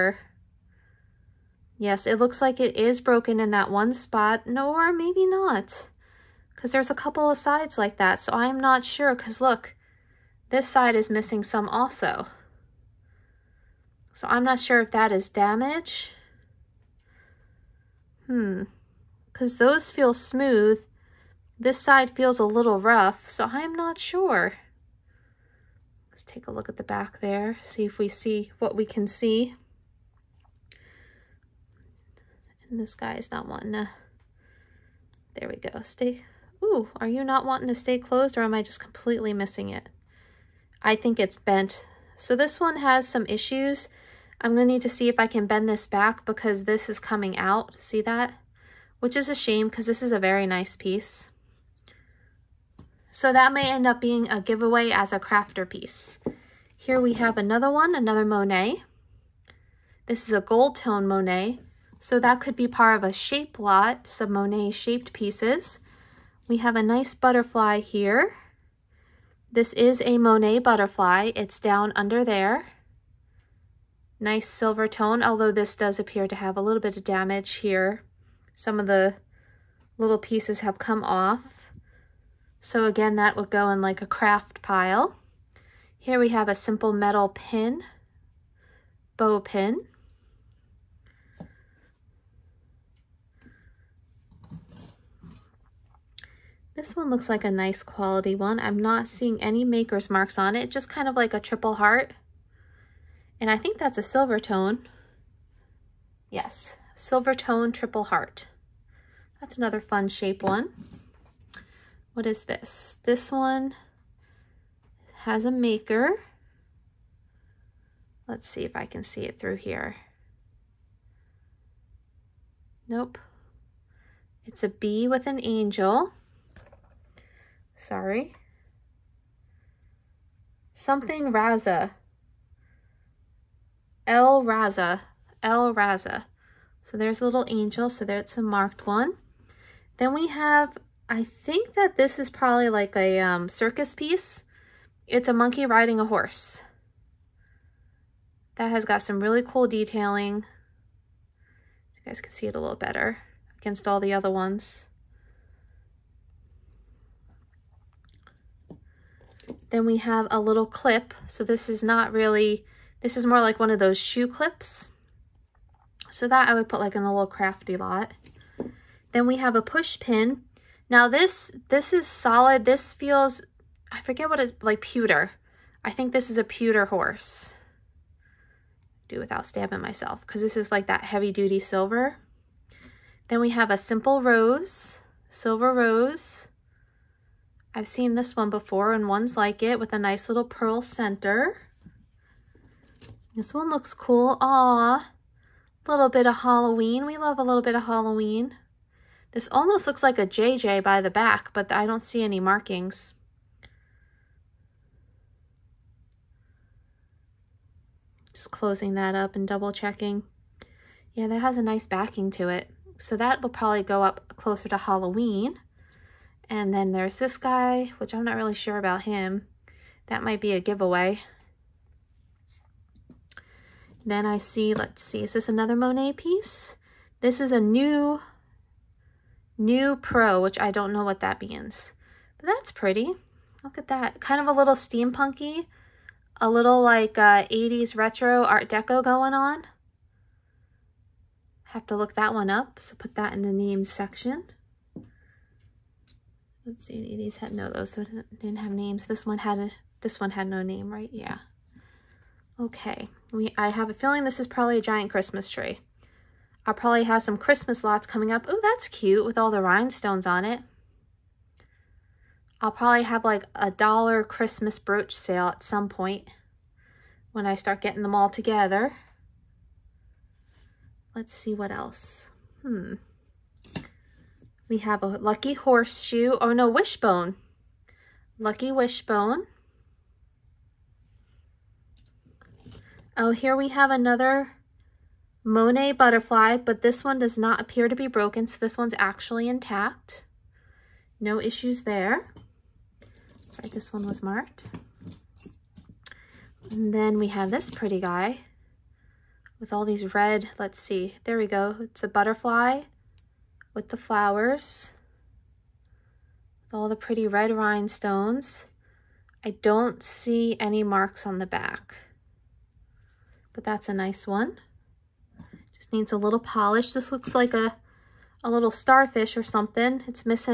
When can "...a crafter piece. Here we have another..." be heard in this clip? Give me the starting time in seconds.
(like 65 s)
55 s.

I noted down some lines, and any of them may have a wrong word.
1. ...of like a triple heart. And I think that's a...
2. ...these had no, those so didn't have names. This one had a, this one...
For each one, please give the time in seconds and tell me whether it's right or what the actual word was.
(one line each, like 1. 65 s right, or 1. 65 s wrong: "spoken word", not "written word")
1. 101 s right
2. 247 s right.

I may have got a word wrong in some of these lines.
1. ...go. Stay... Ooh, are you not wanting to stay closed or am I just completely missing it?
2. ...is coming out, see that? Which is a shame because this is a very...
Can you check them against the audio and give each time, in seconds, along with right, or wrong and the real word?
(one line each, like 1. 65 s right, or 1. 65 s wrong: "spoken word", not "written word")
1. 35 s right
2. 46 s right.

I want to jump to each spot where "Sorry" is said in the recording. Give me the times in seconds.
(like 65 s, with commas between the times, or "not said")
127 s, 293 s.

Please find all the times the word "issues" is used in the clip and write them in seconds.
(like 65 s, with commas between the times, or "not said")
43 s, 291 s.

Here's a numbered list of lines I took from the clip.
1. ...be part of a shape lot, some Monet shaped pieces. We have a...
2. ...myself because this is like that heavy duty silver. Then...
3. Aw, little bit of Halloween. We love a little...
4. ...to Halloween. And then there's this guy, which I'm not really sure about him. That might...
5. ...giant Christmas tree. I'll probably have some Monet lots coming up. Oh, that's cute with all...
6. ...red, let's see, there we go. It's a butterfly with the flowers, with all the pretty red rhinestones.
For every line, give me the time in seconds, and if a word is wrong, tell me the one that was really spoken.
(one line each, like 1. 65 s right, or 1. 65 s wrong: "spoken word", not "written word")
1. 62 s right
2. 179 s right
3. 194 s right
4. 214 s right
5. 254 s wrong: "Christmas", not "Monet"
6. 300 s right.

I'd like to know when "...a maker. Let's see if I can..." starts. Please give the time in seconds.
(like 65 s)
115 s.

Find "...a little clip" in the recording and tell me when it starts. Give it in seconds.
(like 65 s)
160 s.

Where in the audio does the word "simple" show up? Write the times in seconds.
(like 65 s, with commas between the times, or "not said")
86 s, 183 s.